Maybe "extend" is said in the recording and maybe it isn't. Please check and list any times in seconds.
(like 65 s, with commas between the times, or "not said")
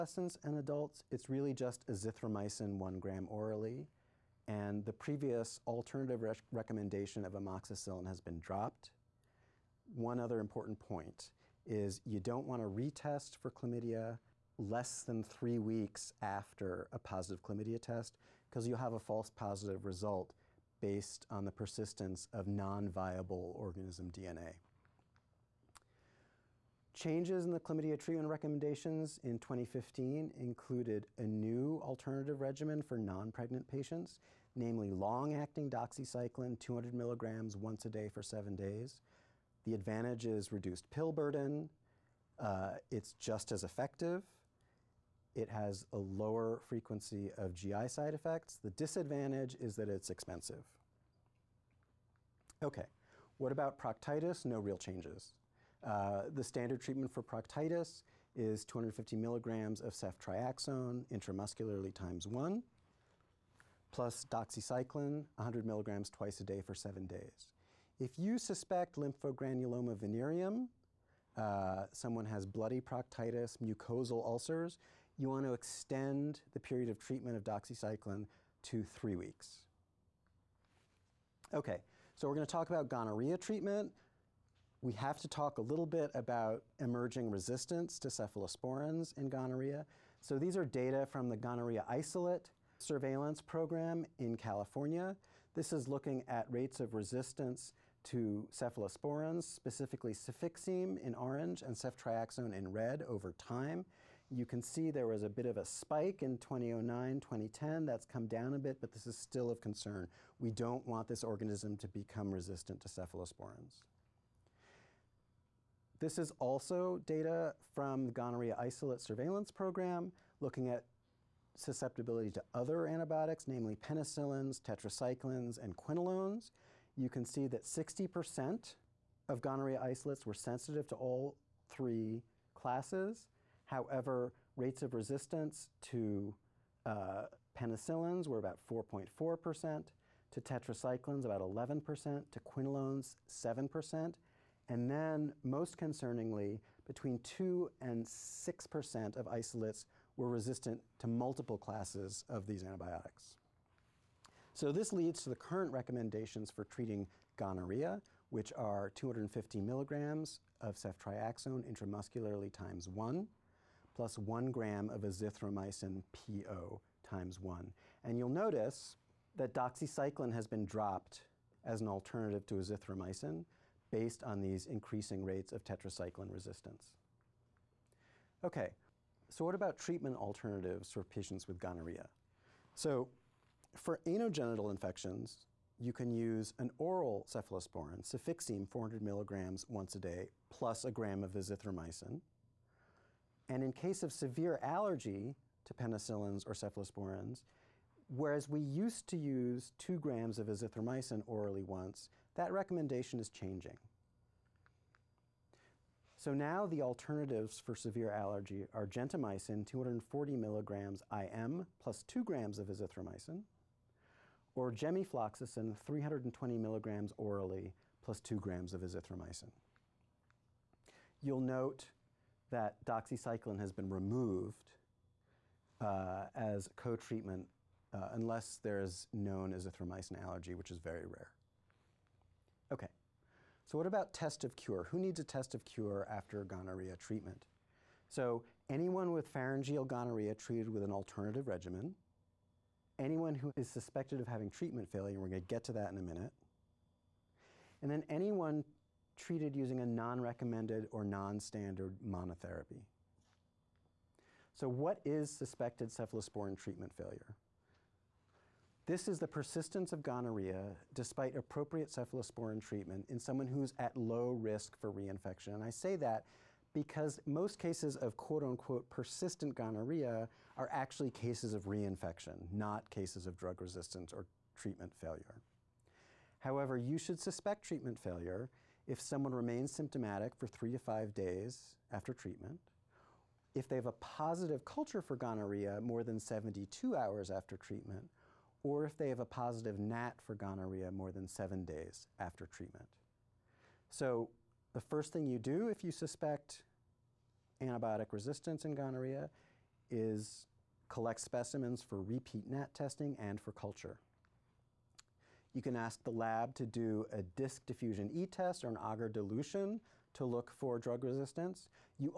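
75 s.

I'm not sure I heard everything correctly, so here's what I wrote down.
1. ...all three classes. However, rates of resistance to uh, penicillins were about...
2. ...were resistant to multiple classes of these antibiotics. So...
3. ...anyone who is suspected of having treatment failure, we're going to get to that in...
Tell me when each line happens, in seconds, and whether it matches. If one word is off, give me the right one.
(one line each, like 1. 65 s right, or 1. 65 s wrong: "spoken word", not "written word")
1. 130 s right
2. 150 s right
3. 243 s right.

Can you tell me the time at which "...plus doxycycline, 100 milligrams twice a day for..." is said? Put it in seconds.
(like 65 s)
63 s.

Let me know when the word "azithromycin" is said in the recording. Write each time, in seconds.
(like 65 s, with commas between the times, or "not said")
1 s, 165 s, 172 s, 191 s, 200 s, 212 s, 218 s, 229 s.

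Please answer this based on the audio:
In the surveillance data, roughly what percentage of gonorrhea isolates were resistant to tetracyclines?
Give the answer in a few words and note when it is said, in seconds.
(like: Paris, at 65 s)
11%, at 141 s.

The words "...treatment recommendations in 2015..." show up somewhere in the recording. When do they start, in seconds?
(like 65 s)
27 s.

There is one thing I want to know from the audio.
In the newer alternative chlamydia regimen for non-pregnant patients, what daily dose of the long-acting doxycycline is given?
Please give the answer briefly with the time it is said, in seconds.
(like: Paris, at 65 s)
200 milligrams, at 36 s.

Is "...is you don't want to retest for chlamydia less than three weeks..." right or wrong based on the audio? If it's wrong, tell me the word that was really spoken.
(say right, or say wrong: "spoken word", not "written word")
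right.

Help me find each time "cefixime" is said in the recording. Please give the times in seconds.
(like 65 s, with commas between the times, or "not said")
100 s, 187 s.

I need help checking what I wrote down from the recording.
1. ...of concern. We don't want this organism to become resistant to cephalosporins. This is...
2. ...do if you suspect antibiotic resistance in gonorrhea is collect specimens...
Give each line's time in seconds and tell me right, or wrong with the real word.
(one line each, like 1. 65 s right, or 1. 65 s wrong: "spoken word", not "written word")
1. 109 s right
2. 295 s right.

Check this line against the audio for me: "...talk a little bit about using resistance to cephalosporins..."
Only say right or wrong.
wrong.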